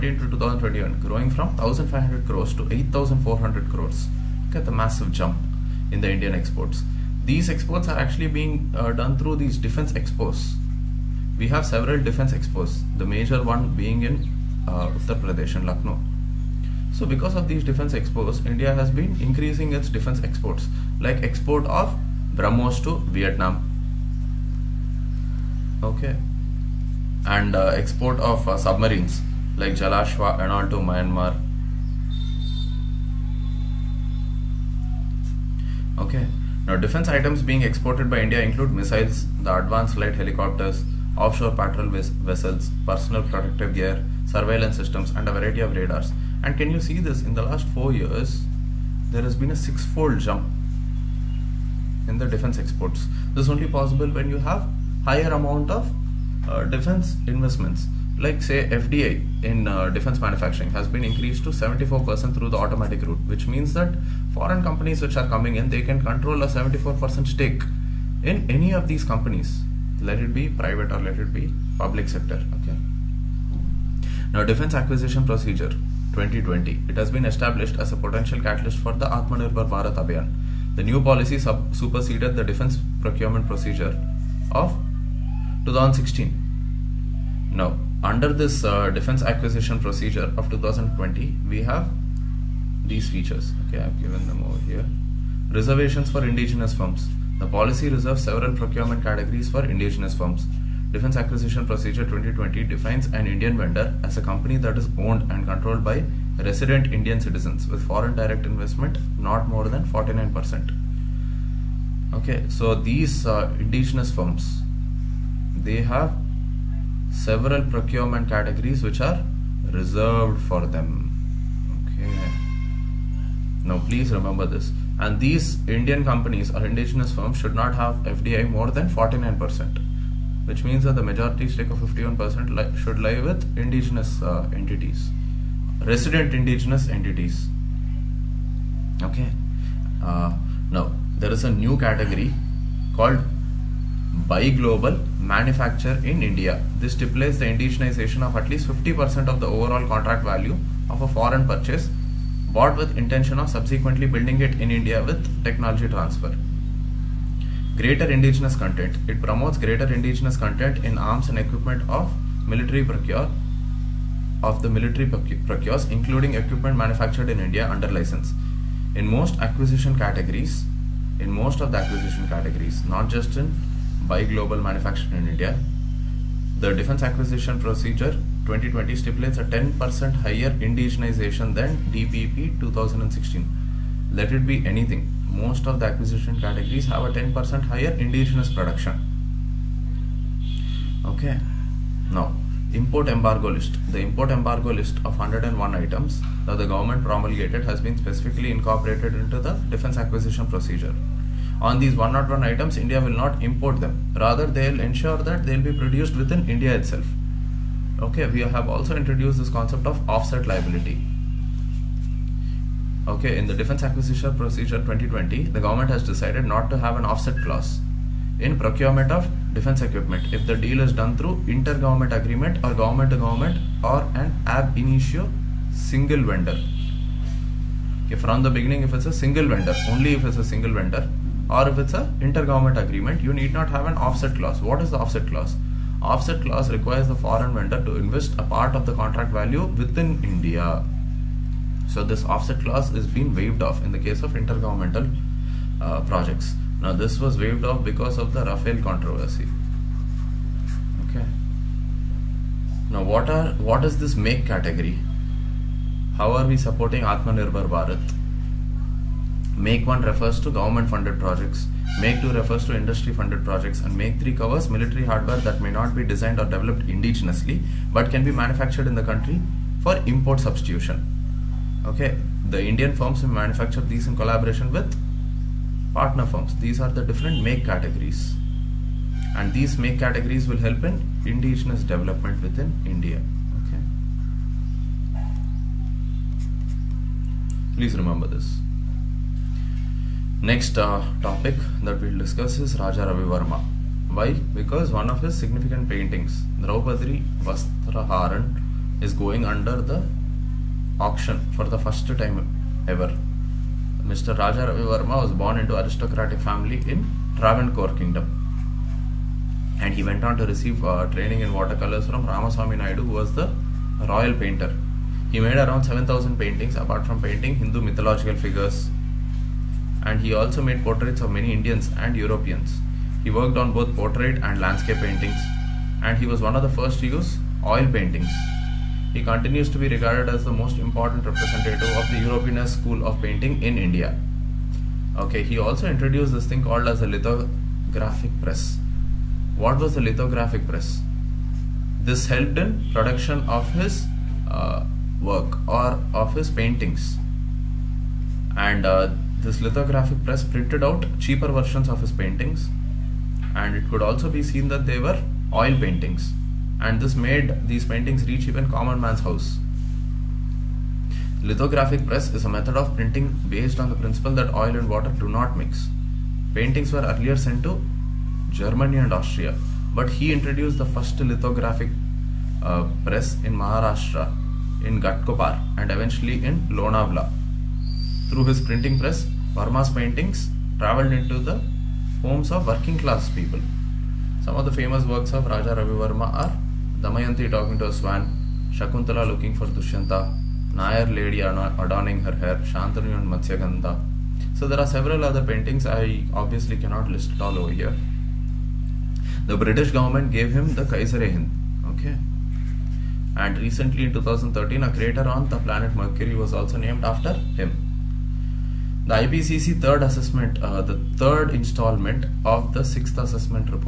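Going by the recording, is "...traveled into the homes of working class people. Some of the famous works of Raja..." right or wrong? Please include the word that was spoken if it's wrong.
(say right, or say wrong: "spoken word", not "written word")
right.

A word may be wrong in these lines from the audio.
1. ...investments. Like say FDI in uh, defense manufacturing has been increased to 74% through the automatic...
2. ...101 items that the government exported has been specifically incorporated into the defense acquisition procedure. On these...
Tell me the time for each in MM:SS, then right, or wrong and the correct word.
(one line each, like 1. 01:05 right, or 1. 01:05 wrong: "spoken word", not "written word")
1. 00:57 right
2. 03:15 wrong: "promulgated", not "exported".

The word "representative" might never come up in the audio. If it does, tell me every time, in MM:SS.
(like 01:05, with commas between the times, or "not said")
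05:31.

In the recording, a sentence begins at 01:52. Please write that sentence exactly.
Okay, so these uh, indigenous firms, they have several procurement categories which are reserved for them.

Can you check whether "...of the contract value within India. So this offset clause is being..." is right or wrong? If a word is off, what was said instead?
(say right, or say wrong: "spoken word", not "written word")
right.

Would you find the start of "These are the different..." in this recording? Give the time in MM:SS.
04:36.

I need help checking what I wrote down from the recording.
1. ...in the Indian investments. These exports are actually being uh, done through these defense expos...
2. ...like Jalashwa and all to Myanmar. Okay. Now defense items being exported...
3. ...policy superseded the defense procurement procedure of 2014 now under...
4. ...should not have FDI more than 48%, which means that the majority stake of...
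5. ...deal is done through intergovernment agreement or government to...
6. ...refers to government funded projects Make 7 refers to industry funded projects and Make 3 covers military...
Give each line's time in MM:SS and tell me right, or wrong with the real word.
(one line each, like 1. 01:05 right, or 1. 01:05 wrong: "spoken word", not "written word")
1. 00:05 wrong: "exports", not "investments"
2. 00:29 right
3. 01:21 wrong: "2016", not "2014"
4. 02:07 wrong: "49", not "48"
5. 03:40 right
6. 04:20 wrong: "2", not "7".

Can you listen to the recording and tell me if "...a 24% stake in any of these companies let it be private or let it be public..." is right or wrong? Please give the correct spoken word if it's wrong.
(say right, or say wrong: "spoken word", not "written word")
wrong: "74", not "24".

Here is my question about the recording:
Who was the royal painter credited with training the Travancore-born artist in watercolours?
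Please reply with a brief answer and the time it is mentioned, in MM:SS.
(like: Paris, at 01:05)
Ramaswamy Naidu, at 05:12.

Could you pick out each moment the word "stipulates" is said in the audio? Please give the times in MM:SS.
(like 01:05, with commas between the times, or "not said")
02:26, 02:58.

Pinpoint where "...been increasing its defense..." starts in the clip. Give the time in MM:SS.
00:18.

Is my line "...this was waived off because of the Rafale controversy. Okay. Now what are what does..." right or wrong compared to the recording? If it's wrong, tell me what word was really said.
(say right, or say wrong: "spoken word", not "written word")
right.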